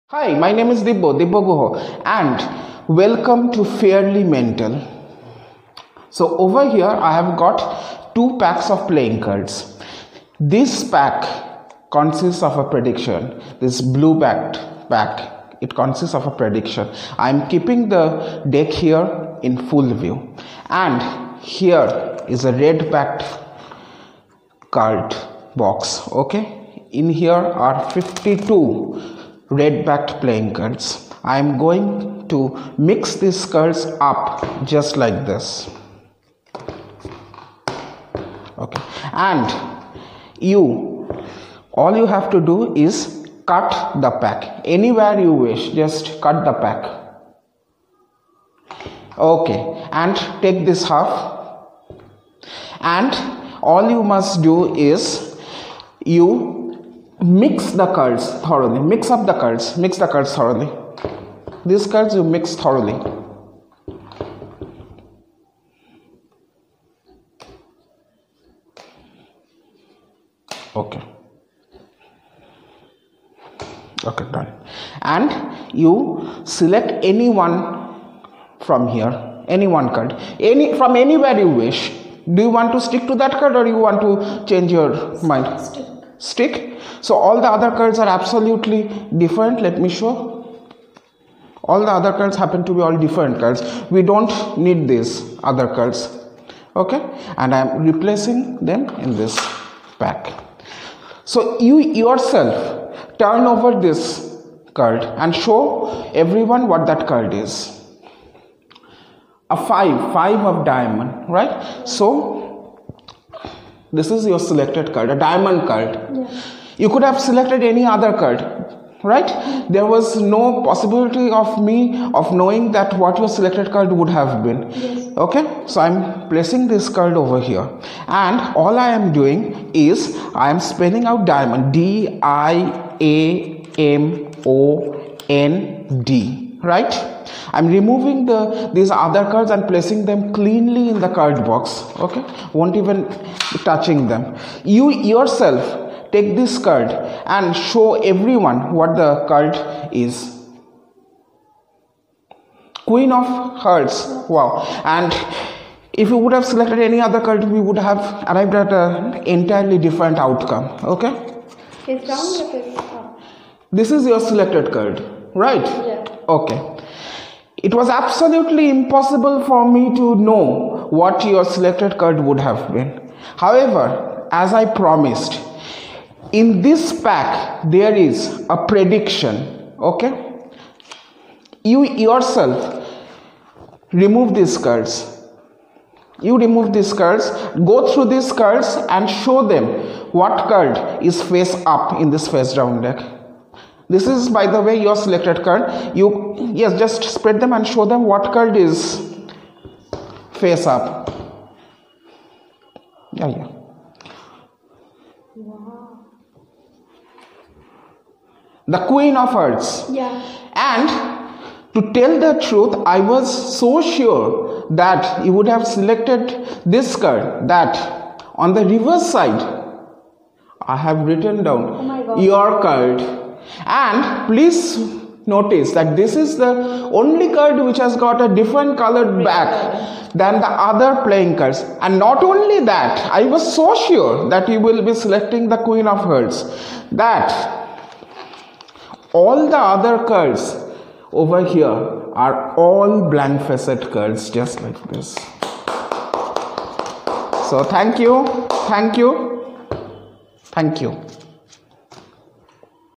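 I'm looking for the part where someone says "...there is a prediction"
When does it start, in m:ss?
2:57.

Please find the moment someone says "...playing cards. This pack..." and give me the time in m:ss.
0:08.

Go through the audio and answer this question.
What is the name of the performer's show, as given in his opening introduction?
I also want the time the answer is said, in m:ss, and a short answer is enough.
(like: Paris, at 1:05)
Fairly Mental, at 0:03.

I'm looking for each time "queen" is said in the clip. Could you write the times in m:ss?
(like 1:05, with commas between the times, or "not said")
2:32, 3:28, 3:55.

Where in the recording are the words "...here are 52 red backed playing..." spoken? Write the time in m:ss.
0:27.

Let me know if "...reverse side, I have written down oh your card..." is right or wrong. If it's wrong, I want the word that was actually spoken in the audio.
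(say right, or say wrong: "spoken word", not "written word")
right.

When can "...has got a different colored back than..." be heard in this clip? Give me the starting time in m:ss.
3:47.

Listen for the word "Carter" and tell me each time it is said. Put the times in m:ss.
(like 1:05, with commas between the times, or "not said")
not said.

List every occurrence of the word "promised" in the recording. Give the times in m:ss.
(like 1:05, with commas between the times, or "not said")
2:54.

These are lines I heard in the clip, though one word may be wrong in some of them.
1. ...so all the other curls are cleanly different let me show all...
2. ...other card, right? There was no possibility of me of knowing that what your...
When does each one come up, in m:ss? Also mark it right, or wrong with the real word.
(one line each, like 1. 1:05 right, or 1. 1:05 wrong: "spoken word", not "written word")
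1. 1:27 wrong: "absolutely", not "cleanly"
2. 1:57 right.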